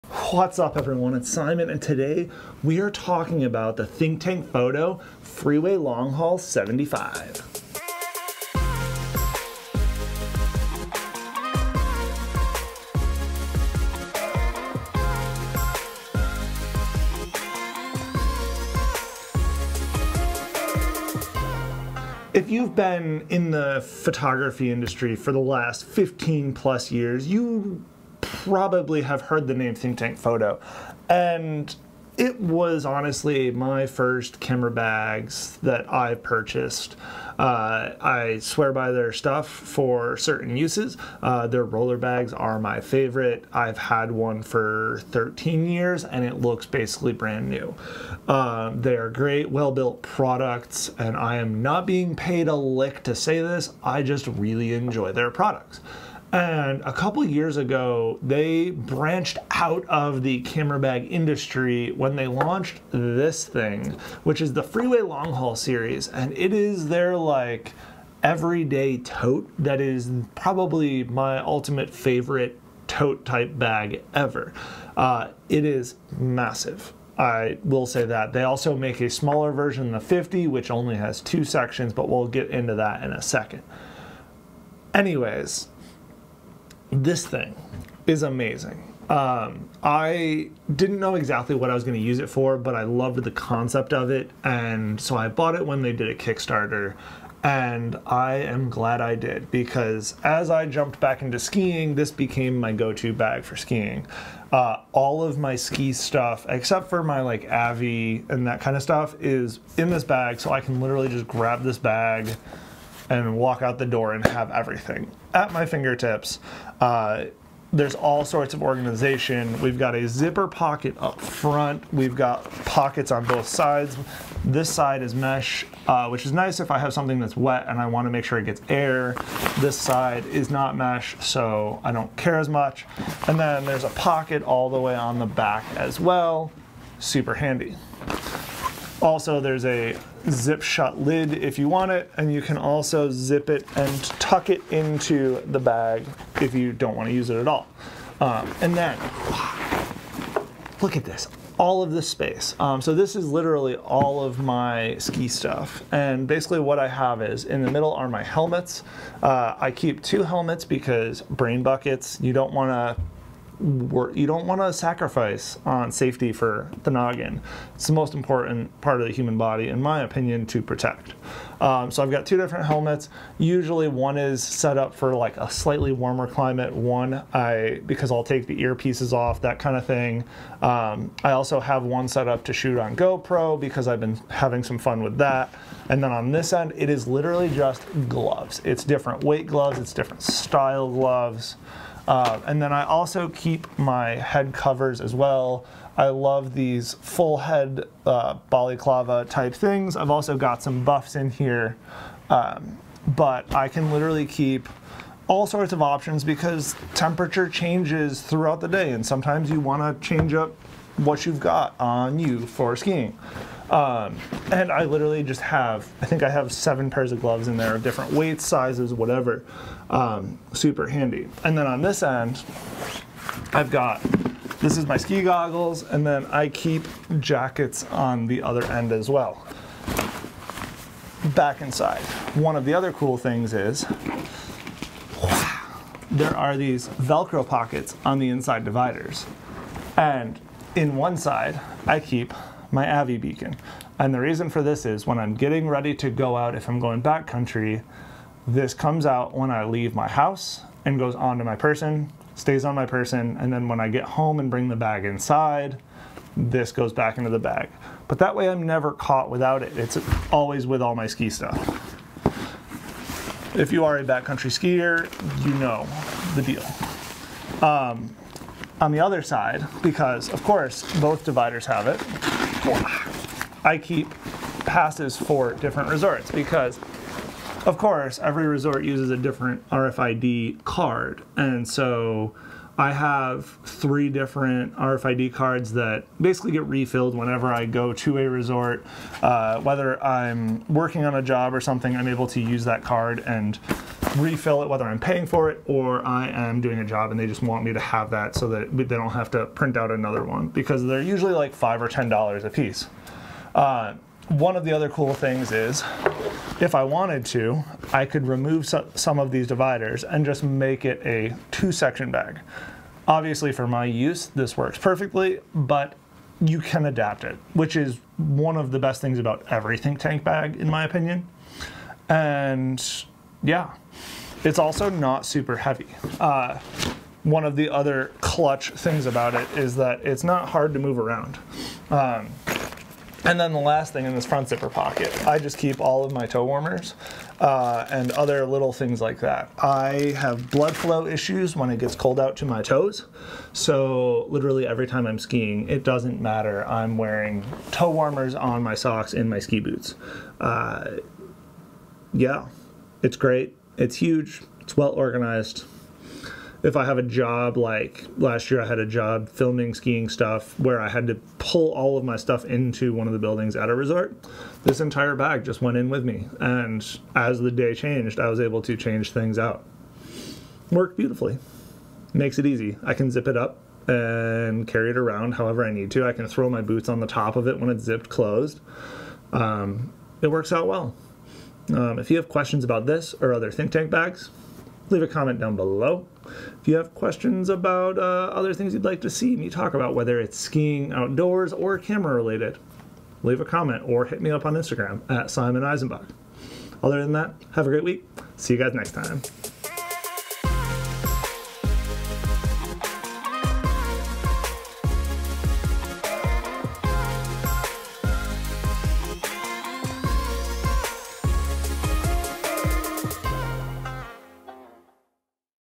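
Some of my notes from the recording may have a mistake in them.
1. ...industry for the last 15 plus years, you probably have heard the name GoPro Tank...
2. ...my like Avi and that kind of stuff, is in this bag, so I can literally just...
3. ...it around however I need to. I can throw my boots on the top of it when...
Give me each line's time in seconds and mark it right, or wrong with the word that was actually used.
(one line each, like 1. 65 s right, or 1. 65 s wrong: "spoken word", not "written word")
1. 24 s wrong: "Think", not "GoPro"
2. 107 s right
3. 374 s right.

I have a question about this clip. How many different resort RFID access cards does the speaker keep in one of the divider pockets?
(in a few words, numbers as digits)
3.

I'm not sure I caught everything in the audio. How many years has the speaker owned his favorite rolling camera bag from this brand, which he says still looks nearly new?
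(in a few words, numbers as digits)
13.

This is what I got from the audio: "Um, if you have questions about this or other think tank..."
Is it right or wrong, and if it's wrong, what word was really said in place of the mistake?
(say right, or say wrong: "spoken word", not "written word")
right.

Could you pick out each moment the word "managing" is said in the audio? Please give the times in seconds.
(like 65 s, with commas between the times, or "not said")
not said.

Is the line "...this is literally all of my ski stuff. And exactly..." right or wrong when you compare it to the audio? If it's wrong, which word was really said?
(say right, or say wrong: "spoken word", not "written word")
wrong: "basically", not "exactly".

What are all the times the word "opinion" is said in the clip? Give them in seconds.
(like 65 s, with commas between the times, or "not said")
170 s, 320 s.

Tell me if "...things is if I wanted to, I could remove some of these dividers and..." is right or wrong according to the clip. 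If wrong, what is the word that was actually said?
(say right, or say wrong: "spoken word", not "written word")
right.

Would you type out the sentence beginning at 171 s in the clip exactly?
Um, so I've got two different helmets.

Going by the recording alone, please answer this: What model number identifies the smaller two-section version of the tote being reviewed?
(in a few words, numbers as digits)
50.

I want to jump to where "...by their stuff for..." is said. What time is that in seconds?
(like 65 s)
38 s.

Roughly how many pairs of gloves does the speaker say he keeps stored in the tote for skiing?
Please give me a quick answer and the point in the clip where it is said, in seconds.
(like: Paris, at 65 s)
7, at 216 s.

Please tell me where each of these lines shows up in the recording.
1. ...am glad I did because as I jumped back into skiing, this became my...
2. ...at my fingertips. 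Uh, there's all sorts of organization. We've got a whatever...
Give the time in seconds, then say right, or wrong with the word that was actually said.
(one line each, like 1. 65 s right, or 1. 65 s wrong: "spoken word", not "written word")
1. 98 s right
2. 115 s wrong: "zipper", not "whatever".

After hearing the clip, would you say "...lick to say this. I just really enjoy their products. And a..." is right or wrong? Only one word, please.
right.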